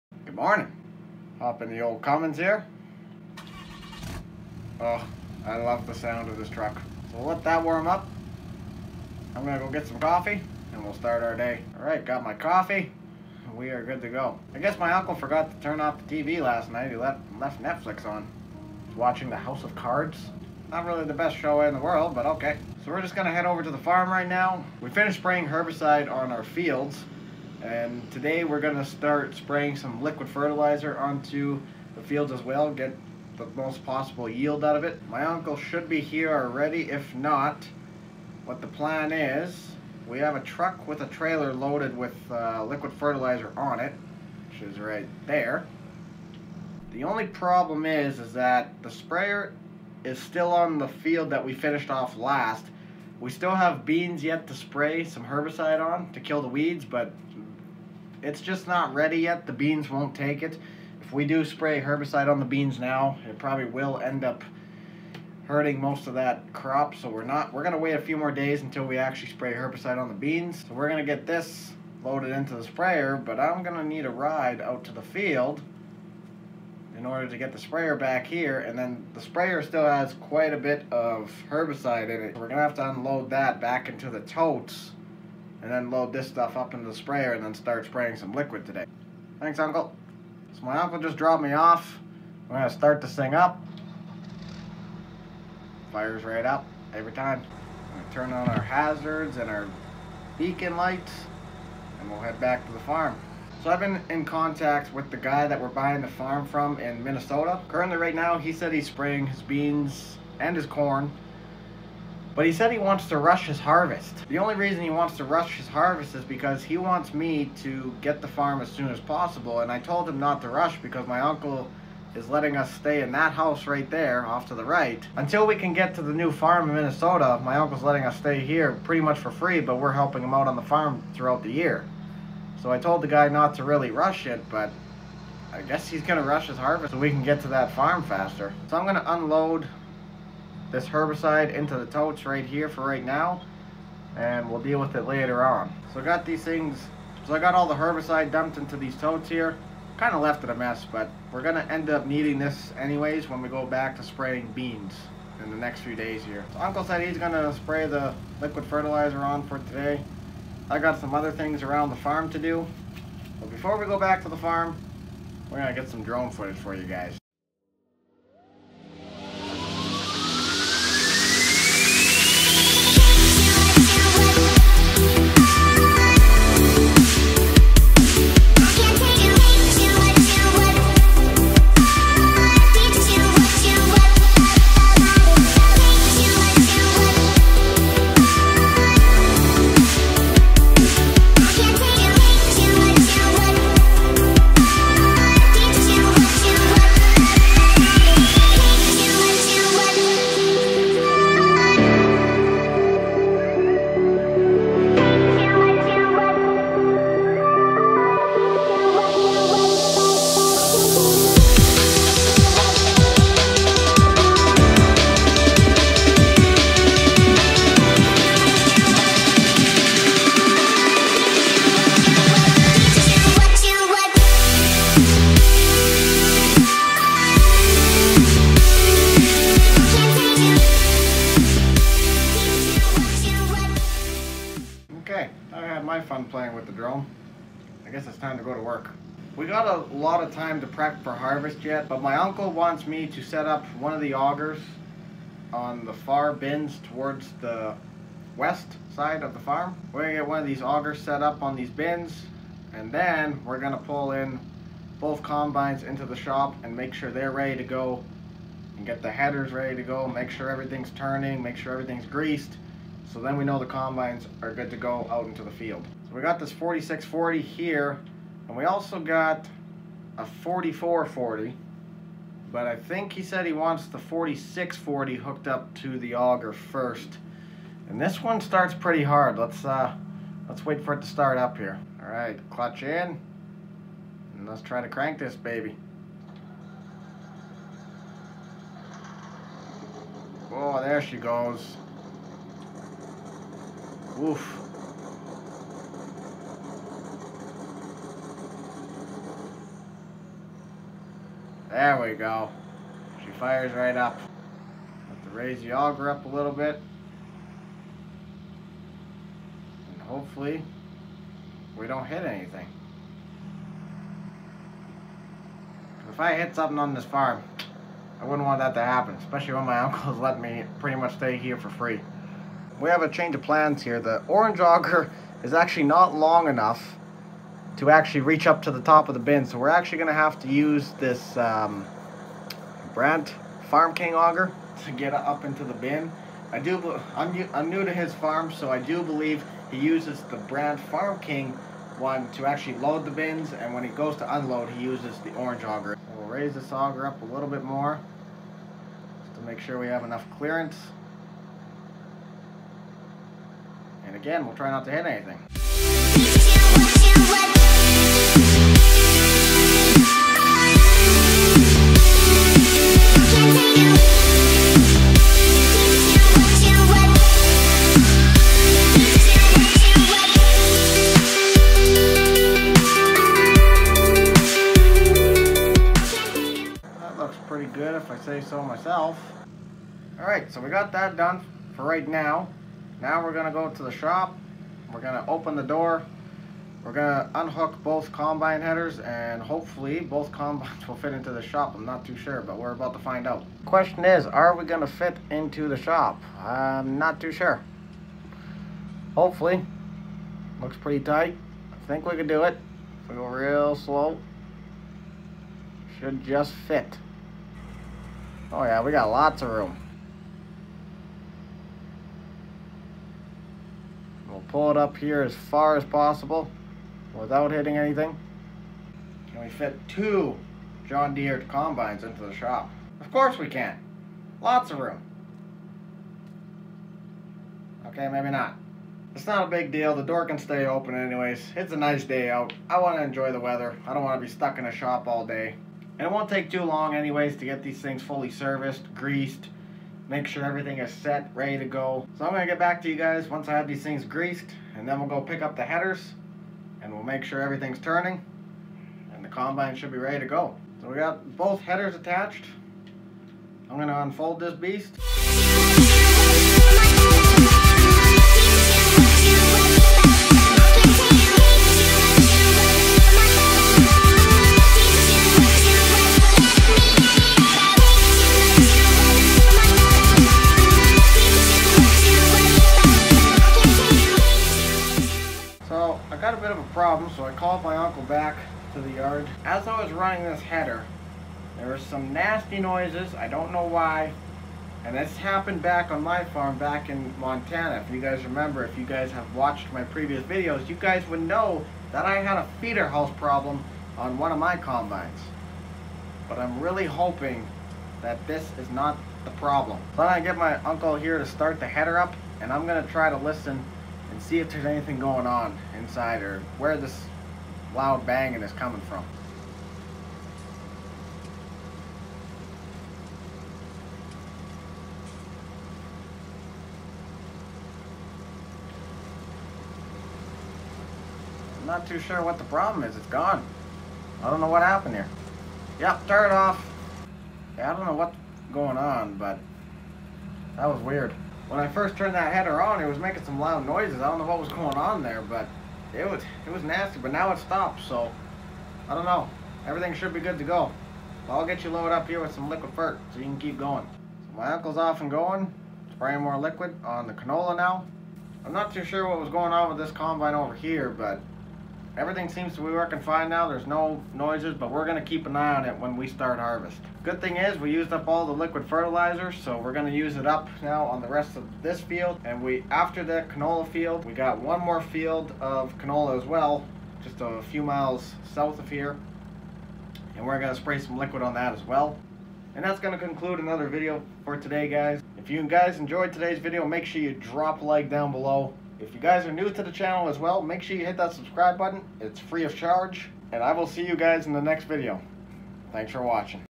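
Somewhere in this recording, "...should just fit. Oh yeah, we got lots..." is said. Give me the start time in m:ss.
6:45.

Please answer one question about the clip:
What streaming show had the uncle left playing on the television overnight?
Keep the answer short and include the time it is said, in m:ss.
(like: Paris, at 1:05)
House of Cards, at 0:19.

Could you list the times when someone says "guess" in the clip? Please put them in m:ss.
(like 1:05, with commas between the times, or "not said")
0:14, 2:15, 3:57.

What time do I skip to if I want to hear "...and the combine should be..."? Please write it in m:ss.
7:29.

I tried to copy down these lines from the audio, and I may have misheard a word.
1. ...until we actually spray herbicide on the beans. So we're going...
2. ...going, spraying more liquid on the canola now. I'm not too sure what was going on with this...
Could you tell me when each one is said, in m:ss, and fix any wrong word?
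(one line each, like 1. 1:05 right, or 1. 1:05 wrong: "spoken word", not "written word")
1. 1:08 right
2. 9:05 right.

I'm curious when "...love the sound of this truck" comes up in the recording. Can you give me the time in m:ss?
0:05.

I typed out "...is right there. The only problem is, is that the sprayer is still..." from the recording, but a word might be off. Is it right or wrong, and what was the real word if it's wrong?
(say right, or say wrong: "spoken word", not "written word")
right.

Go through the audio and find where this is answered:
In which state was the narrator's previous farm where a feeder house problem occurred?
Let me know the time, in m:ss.
8:07.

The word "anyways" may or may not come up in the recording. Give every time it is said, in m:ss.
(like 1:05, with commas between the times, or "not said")
2:32, 7:10, 7:16.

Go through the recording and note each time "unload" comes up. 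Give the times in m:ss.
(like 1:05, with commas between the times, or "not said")
1:22, 2:19, 5:44.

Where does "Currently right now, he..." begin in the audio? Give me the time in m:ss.
1:47.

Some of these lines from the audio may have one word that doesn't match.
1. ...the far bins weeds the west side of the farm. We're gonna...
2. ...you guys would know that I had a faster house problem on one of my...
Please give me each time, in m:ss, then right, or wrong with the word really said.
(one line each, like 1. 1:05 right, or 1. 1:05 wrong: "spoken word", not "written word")
1. 4:05 wrong: "towards", not "weeds"
2. 8:10 wrong: "feeder", not "faster".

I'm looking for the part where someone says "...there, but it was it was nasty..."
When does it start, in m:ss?
8:55.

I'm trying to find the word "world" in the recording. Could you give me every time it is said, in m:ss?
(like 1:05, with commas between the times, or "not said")
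0:21.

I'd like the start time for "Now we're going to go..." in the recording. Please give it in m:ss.
6:23.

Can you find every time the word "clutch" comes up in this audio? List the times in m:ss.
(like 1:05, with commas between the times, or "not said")
4:42.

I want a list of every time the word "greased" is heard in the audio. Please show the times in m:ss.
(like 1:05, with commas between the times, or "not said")
4:22, 7:18, 7:24.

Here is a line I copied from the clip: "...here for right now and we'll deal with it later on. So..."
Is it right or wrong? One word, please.
right.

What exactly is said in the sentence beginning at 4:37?
And this one starts pretty hard.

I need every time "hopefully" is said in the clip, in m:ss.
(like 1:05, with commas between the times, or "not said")
5:10, 6:29, 6:39.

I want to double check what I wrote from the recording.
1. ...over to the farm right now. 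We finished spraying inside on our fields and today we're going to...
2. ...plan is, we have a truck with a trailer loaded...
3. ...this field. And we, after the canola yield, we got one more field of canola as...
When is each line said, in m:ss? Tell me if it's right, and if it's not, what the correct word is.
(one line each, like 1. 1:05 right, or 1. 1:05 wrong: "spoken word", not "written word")
1. 0:23 wrong: "herbicide", not "inside"
2. 0:38 right
3. 9:21 wrong: "field", not "yield".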